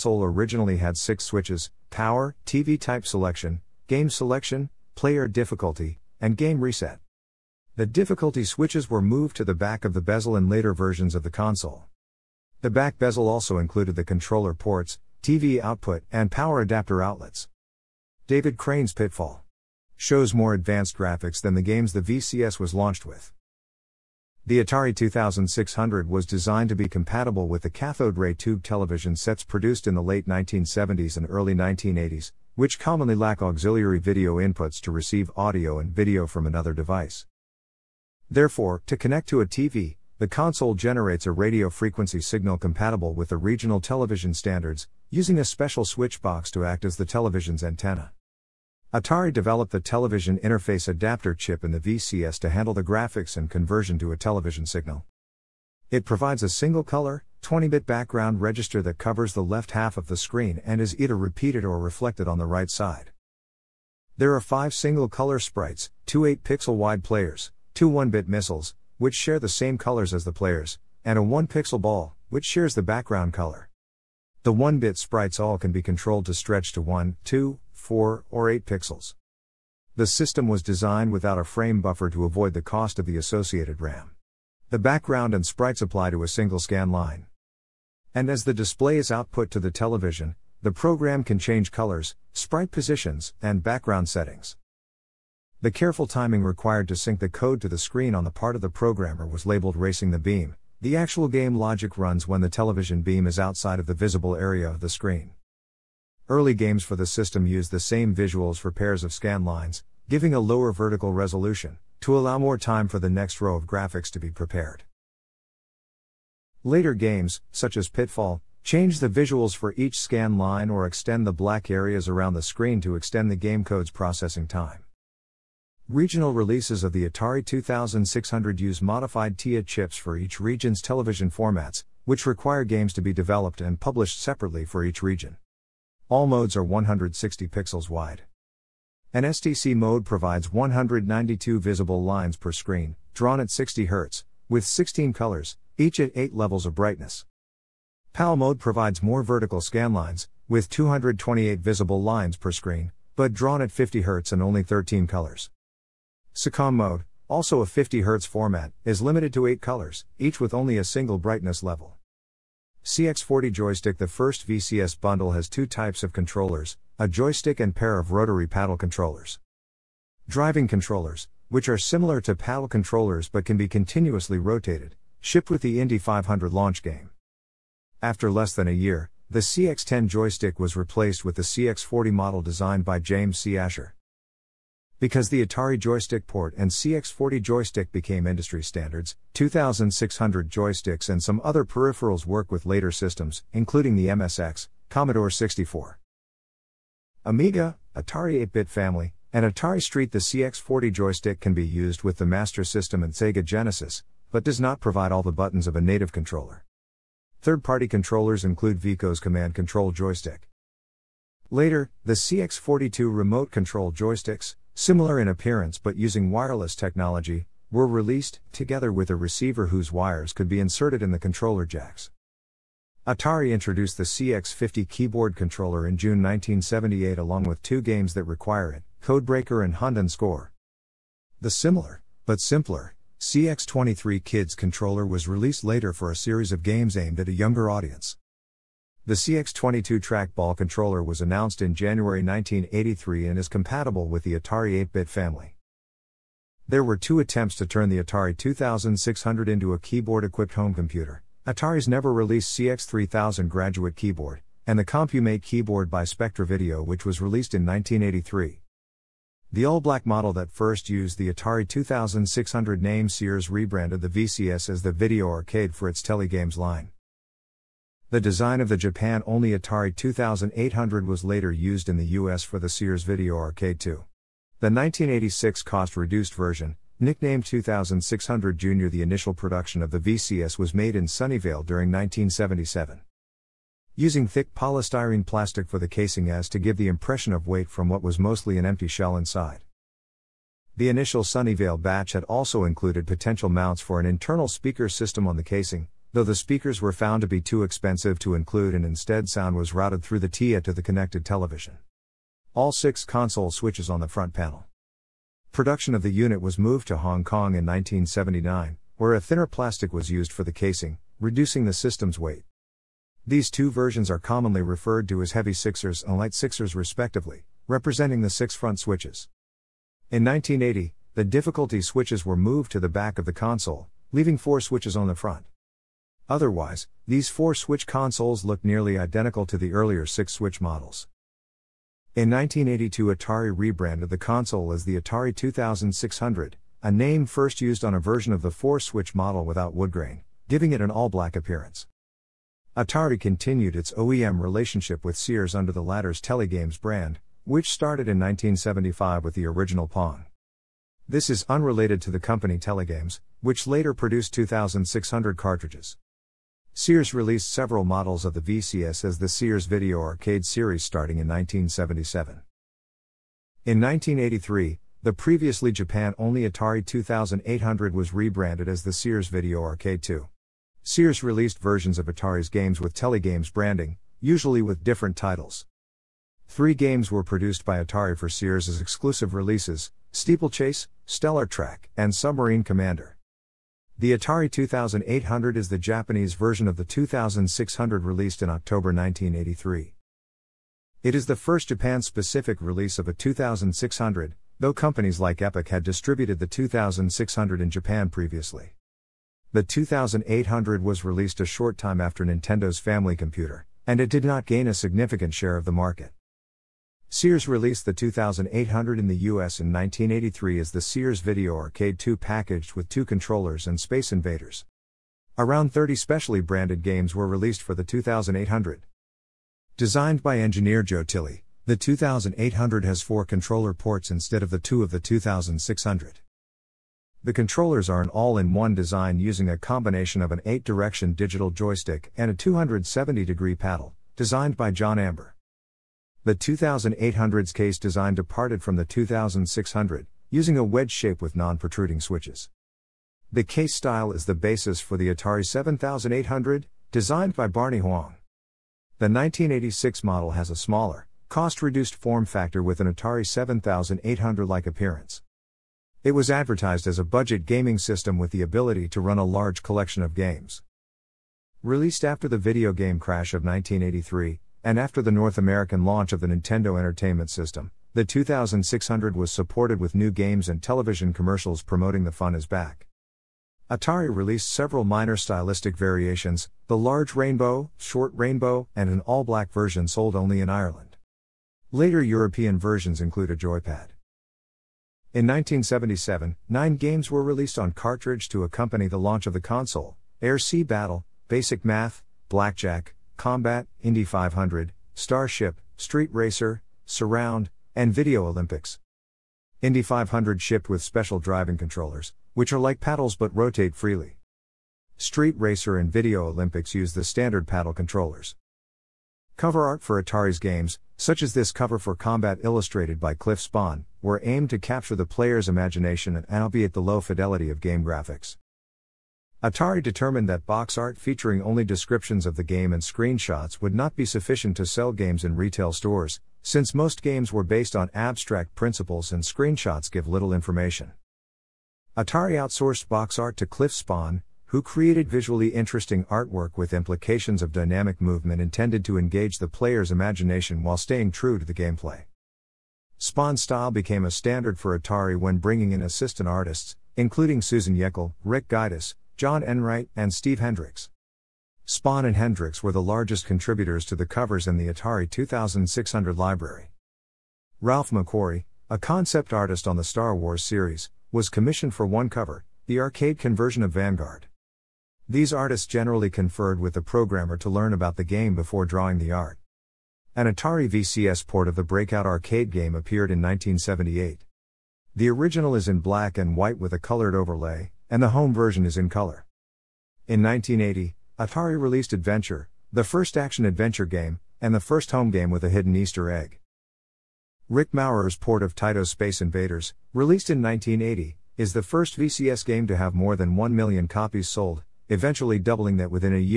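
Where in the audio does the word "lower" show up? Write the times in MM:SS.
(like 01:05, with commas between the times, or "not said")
01:50.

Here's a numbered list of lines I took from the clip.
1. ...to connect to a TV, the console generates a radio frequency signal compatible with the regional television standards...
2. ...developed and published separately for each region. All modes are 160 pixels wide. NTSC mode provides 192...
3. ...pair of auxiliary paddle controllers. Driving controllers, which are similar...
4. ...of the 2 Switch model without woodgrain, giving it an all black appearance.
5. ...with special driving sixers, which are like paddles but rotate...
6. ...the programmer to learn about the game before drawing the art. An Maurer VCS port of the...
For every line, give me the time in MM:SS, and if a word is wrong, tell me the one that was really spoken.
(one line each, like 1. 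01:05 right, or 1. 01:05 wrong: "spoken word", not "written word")
1. 00:38 right
2. 02:13 right
3. 02:47 wrong: "rotary", not "auxiliary"
4. 05:38 wrong: "4", not "2"
5. 08:20 wrong: "controllers", not "sixers"
6. 09:26 wrong: "Atari", not "Maurer".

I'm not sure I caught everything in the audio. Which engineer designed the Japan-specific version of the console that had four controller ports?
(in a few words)
Joe Tilley.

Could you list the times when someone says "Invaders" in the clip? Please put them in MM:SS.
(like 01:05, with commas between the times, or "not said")
06:54, 09:49.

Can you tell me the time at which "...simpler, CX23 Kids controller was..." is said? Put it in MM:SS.
03:52.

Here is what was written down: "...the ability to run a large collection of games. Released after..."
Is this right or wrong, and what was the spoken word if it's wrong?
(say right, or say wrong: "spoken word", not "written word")
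right.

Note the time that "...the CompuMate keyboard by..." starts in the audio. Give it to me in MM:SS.
04:14.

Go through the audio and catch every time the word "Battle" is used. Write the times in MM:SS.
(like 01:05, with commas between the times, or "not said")
08:10.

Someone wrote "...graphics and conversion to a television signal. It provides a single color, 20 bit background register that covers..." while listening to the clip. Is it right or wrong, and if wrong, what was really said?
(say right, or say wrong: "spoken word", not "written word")
right.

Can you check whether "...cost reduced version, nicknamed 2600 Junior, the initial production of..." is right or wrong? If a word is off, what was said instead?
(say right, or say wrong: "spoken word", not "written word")
right.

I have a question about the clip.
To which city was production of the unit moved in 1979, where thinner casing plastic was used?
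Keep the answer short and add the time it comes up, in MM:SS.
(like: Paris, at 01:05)
Hong Kong, at 05:06.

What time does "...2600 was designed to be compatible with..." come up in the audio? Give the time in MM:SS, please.
00:24.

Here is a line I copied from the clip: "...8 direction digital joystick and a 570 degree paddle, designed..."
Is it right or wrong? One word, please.
wrong.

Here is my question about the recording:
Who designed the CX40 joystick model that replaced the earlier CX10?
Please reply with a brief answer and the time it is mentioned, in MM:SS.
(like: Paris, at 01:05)
James C. Asher, at 03:02.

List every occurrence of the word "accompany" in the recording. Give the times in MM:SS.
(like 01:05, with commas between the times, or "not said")
08:08.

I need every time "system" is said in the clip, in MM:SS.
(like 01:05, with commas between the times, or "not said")
01:20, 01:47, 03:12, 03:22, 04:54, 05:11, 07:37, 07:47.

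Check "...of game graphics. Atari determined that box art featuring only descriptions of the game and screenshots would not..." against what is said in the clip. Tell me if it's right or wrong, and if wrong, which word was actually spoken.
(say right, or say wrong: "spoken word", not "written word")
right.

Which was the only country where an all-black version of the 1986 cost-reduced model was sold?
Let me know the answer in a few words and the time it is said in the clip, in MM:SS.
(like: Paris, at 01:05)
Ireland, at 08:00.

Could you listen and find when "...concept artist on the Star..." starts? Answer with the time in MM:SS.
09:18.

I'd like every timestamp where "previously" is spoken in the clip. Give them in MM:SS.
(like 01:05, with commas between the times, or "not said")
06:05, 06:38.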